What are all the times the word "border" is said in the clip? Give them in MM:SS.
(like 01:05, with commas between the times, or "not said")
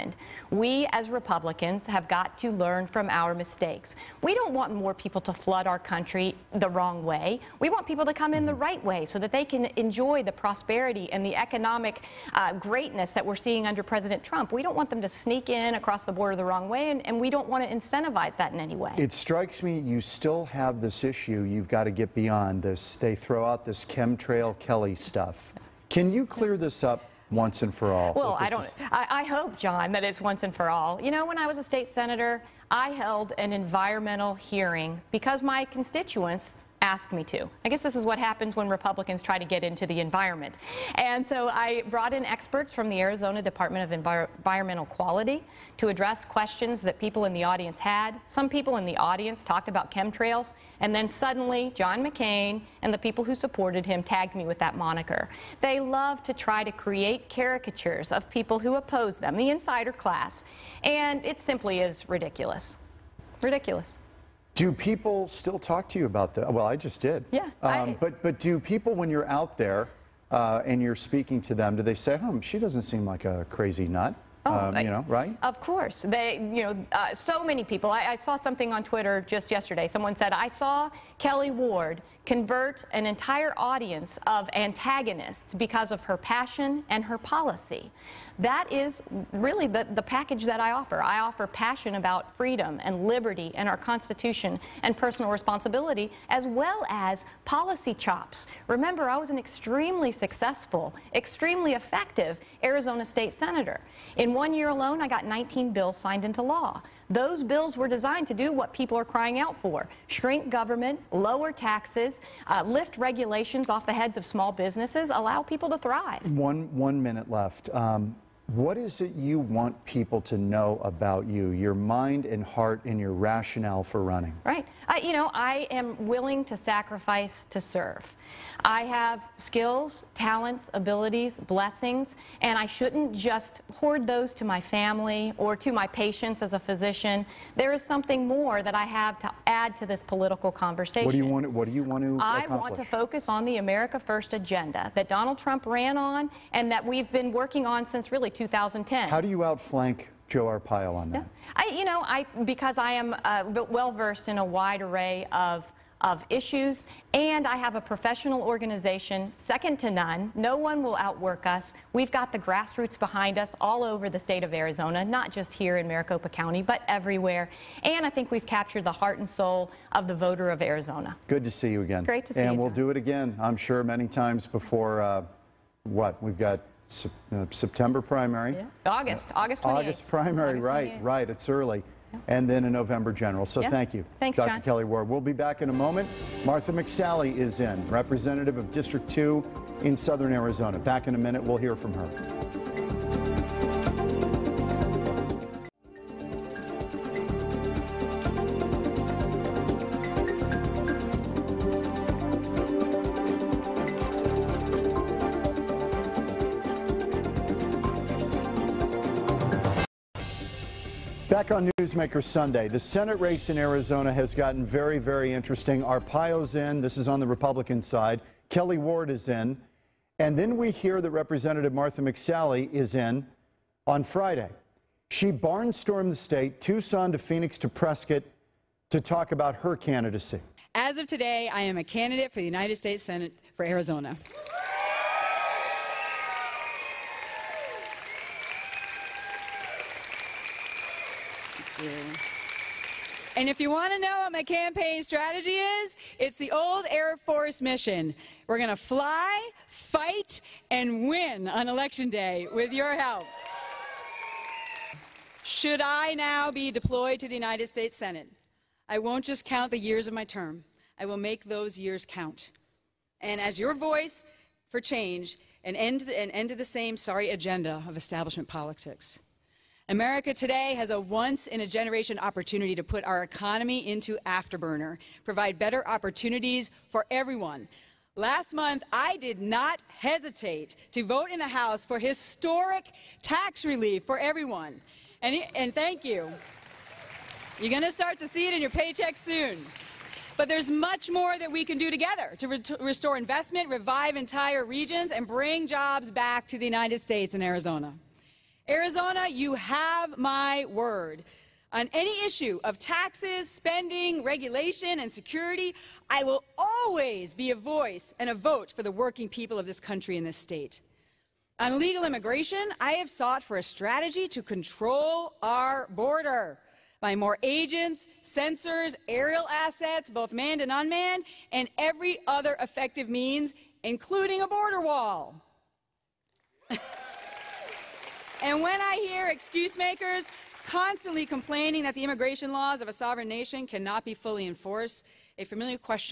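00:16, 05:15, 05:24.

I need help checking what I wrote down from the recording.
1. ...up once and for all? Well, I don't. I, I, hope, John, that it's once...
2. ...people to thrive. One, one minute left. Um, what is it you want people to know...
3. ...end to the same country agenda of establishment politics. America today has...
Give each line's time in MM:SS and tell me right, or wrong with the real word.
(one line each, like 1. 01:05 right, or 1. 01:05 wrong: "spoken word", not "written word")
1. 00:26 right
2. 01:55 right
3. 04:26 wrong: "sorry", not "country".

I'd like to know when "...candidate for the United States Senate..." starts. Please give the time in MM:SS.
03:51.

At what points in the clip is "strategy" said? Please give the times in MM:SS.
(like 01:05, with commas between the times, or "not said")
04:05, 05:13.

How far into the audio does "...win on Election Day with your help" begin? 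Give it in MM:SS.
04:11.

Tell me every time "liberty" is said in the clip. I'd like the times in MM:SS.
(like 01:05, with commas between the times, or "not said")
01:33.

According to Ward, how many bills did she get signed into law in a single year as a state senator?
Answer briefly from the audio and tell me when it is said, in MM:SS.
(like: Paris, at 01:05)
19, at 01:45.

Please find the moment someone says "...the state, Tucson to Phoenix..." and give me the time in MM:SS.
03:46.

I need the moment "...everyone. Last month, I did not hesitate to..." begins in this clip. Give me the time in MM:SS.
04:37.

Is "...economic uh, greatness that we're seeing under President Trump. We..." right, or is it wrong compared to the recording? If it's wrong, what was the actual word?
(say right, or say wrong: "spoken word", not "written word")
right.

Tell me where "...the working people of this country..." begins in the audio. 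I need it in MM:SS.
05:08.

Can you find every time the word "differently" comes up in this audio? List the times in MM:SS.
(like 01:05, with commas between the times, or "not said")
not said.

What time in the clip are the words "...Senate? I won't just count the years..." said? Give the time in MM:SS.
04:17.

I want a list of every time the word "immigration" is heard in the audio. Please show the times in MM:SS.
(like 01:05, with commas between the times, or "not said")
05:12, 05:32.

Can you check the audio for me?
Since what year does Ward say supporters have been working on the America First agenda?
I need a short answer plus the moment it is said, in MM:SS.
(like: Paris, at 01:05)
2010, at 02:28.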